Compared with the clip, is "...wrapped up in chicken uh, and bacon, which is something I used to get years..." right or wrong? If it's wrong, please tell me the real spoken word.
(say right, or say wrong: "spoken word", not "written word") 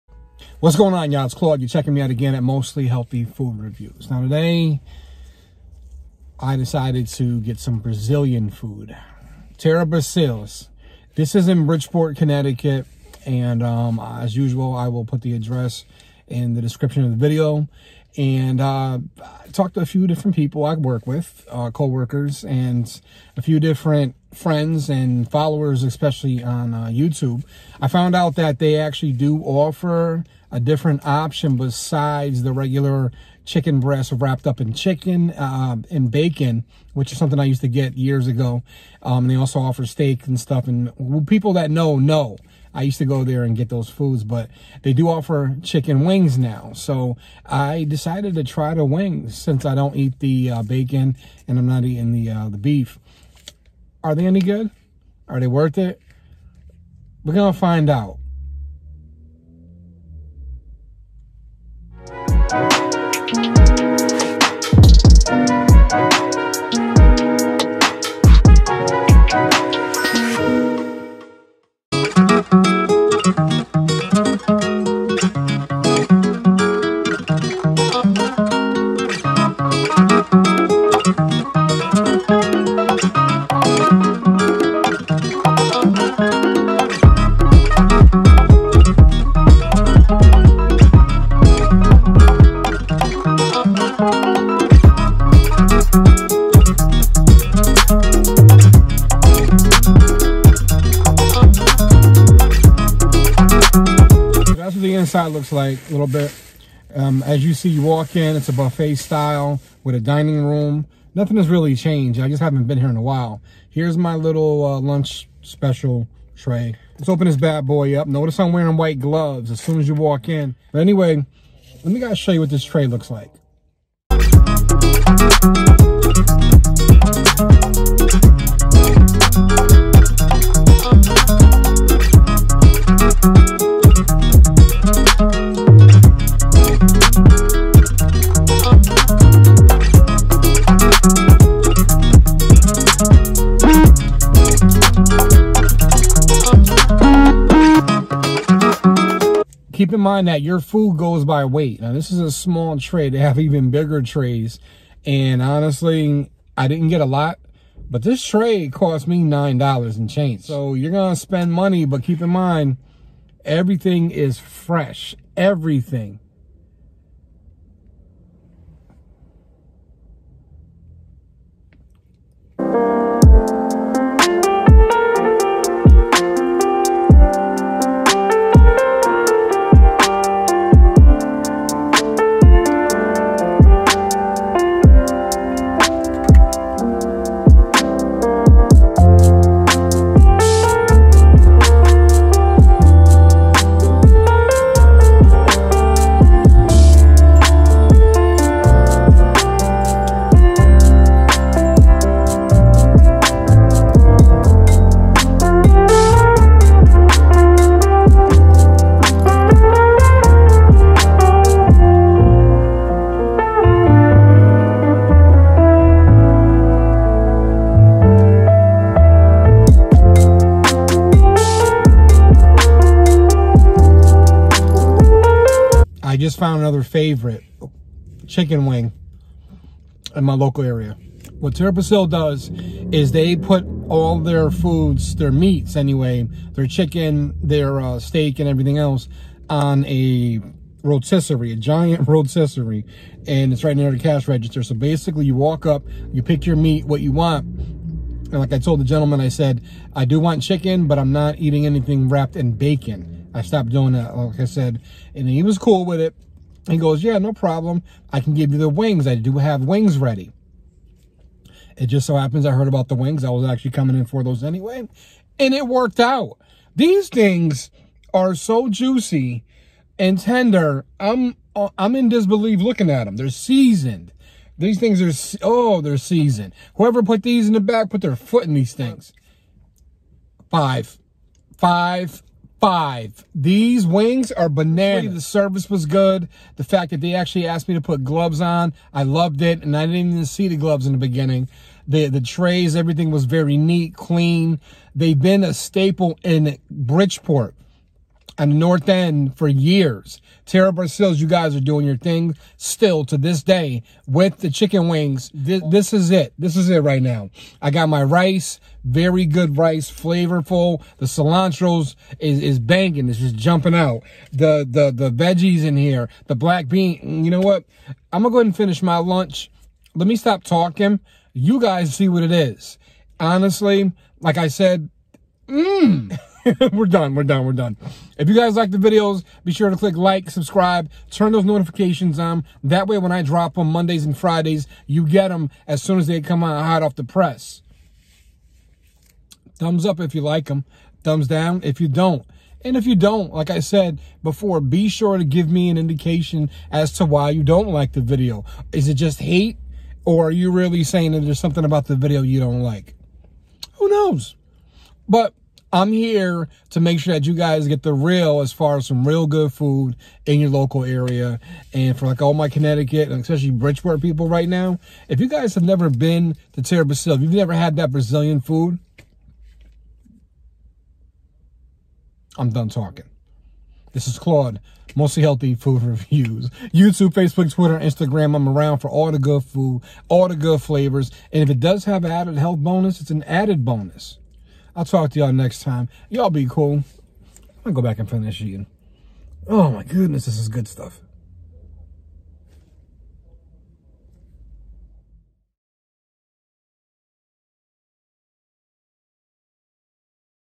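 right.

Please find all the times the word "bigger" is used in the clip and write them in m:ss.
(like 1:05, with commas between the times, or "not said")
2:33.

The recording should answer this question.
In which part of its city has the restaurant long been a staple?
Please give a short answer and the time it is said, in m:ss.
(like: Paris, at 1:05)
North End, at 4:58.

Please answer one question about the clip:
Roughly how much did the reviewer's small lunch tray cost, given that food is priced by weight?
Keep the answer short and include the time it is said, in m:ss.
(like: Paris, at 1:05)
$9, at 2:39.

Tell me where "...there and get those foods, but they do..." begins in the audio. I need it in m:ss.
0:43.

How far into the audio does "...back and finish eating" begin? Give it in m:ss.
6:27.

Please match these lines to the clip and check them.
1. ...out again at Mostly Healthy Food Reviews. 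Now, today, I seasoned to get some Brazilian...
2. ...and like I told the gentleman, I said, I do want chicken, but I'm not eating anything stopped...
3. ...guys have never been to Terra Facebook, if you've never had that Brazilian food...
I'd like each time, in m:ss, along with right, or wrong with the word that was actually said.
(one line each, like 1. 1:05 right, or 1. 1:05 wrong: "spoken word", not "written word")
1. 0:02 wrong: "decided", not "seasoned"
2. 4:07 wrong: "wrapped", not "stopped"
3. 6:05 wrong: "Brasil", not "Facebook".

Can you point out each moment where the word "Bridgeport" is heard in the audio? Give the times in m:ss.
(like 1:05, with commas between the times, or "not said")
0:11, 4:56, 6:03.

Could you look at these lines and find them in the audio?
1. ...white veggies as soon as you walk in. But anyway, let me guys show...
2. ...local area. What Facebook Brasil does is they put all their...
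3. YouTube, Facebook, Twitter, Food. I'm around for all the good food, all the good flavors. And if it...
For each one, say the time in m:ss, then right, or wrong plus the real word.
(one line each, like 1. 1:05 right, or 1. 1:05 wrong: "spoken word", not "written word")
1. 1:58 wrong: "gloves", not "veggies"
2. 3:50 wrong: "Terra", not "Facebook"
3. 6:16 wrong: "Instagram", not "Food".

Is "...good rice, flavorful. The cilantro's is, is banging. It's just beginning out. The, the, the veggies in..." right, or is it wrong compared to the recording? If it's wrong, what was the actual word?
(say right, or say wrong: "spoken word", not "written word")
wrong: "jumping", not "beginning".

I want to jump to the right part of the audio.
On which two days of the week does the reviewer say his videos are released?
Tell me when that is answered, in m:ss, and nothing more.
5:33.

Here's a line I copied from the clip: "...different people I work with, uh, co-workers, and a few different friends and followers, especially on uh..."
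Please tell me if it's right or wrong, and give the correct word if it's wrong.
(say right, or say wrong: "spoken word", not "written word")
right.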